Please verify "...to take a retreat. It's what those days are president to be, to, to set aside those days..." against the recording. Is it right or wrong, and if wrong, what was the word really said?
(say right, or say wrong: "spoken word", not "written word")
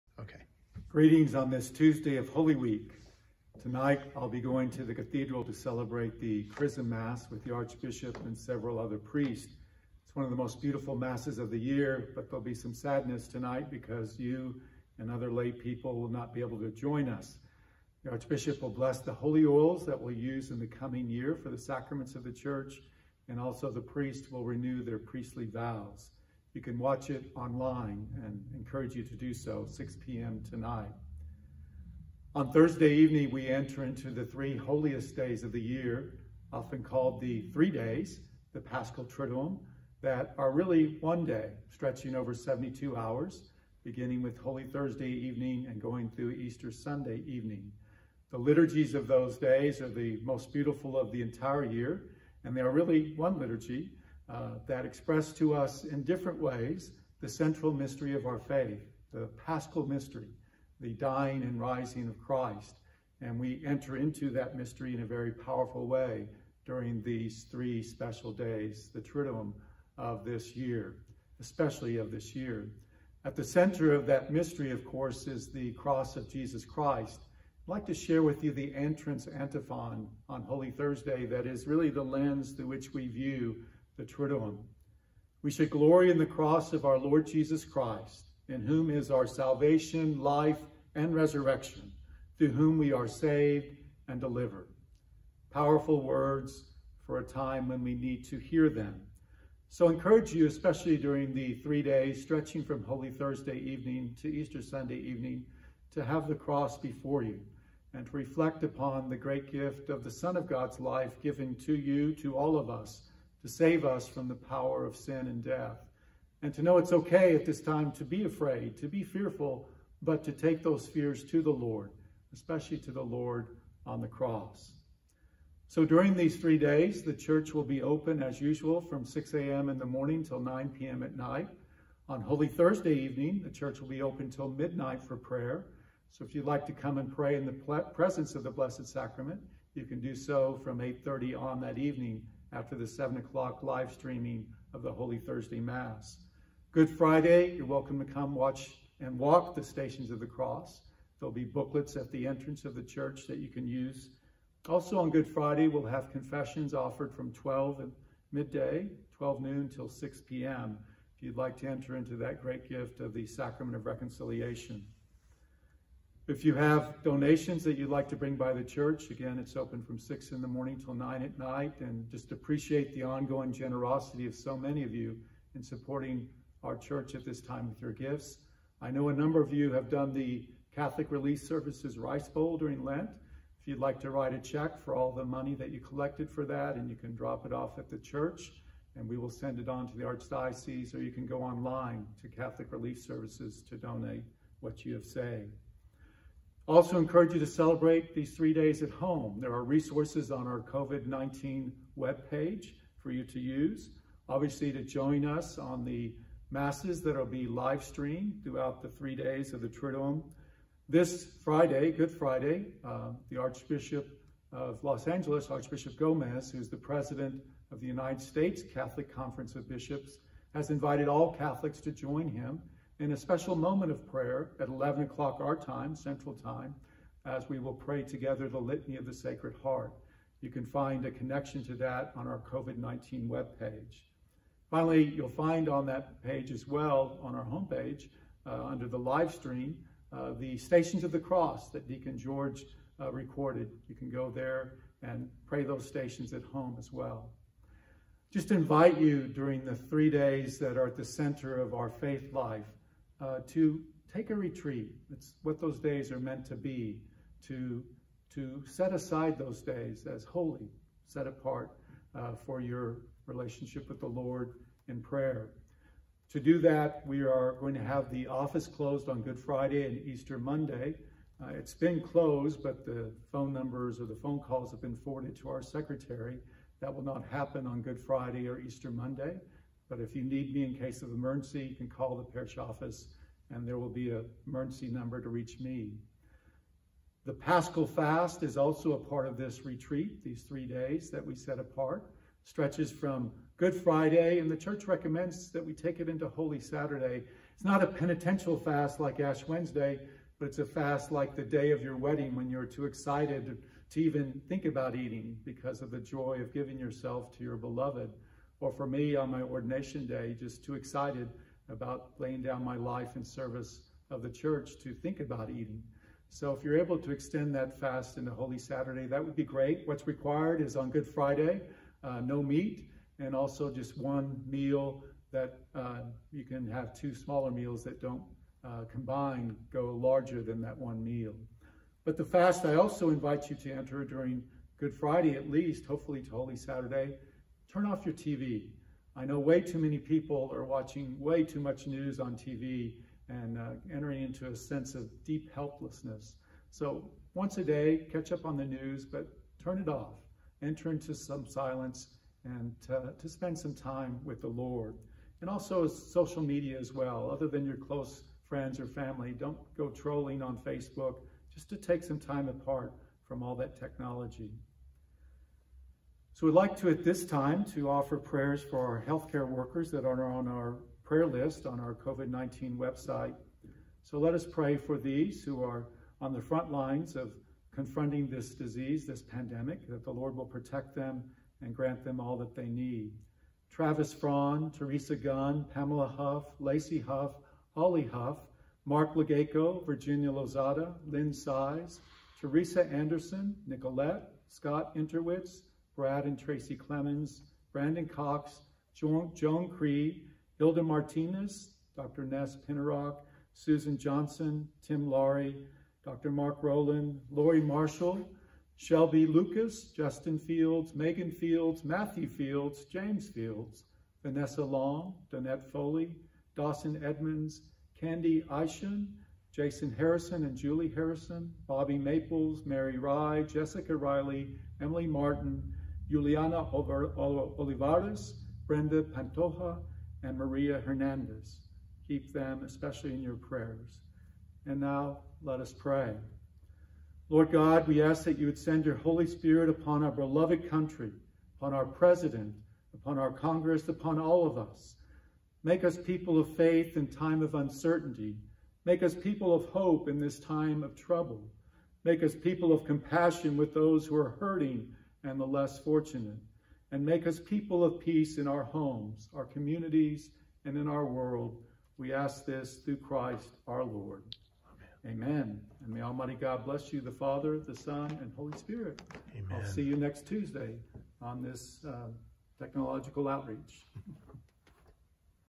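wrong: "meant", not "president".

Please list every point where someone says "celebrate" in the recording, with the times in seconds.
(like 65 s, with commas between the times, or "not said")
5 s, 197 s.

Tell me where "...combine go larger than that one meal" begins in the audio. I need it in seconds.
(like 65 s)
328 s.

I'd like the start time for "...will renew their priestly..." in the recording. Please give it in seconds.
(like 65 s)
24 s.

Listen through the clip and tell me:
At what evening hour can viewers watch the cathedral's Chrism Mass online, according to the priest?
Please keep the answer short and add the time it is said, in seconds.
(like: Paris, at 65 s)
6 p.m., at 29 s.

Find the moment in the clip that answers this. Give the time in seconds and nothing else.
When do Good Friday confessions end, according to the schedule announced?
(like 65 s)
159 s.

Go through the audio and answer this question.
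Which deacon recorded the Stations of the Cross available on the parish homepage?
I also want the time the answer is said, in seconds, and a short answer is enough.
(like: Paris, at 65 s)
Deacon George, at 241 s.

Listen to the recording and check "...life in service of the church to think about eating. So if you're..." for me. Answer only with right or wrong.
right.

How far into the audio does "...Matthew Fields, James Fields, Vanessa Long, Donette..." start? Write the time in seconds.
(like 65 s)
411 s.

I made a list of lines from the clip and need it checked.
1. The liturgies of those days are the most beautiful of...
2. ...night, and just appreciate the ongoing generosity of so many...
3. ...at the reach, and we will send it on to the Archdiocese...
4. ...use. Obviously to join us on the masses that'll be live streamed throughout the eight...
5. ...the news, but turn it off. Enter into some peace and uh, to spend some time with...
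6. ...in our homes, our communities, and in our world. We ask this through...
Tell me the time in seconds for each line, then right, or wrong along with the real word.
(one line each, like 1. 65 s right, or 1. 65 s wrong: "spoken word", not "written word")
1. 48 s right
2. 171 s right
3. 187 s wrong: "church", not "reach"
4. 203 s wrong: "three", not "eight"
5. 348 s wrong: "silence", not "peace"
6. 458 s right.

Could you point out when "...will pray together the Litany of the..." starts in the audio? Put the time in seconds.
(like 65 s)
227 s.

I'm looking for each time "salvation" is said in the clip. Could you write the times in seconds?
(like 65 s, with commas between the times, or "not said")
89 s.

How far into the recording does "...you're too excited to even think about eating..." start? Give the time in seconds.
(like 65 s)
302 s.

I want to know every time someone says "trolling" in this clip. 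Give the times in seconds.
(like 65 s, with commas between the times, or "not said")
359 s.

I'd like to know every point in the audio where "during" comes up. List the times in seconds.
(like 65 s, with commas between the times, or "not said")
66 s, 100 s, 125 s, 182 s, 249 s, 334 s.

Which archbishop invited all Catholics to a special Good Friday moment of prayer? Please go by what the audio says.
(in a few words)
Archbishop Gomez.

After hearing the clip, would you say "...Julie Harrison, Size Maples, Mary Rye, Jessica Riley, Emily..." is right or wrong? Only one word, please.
wrong.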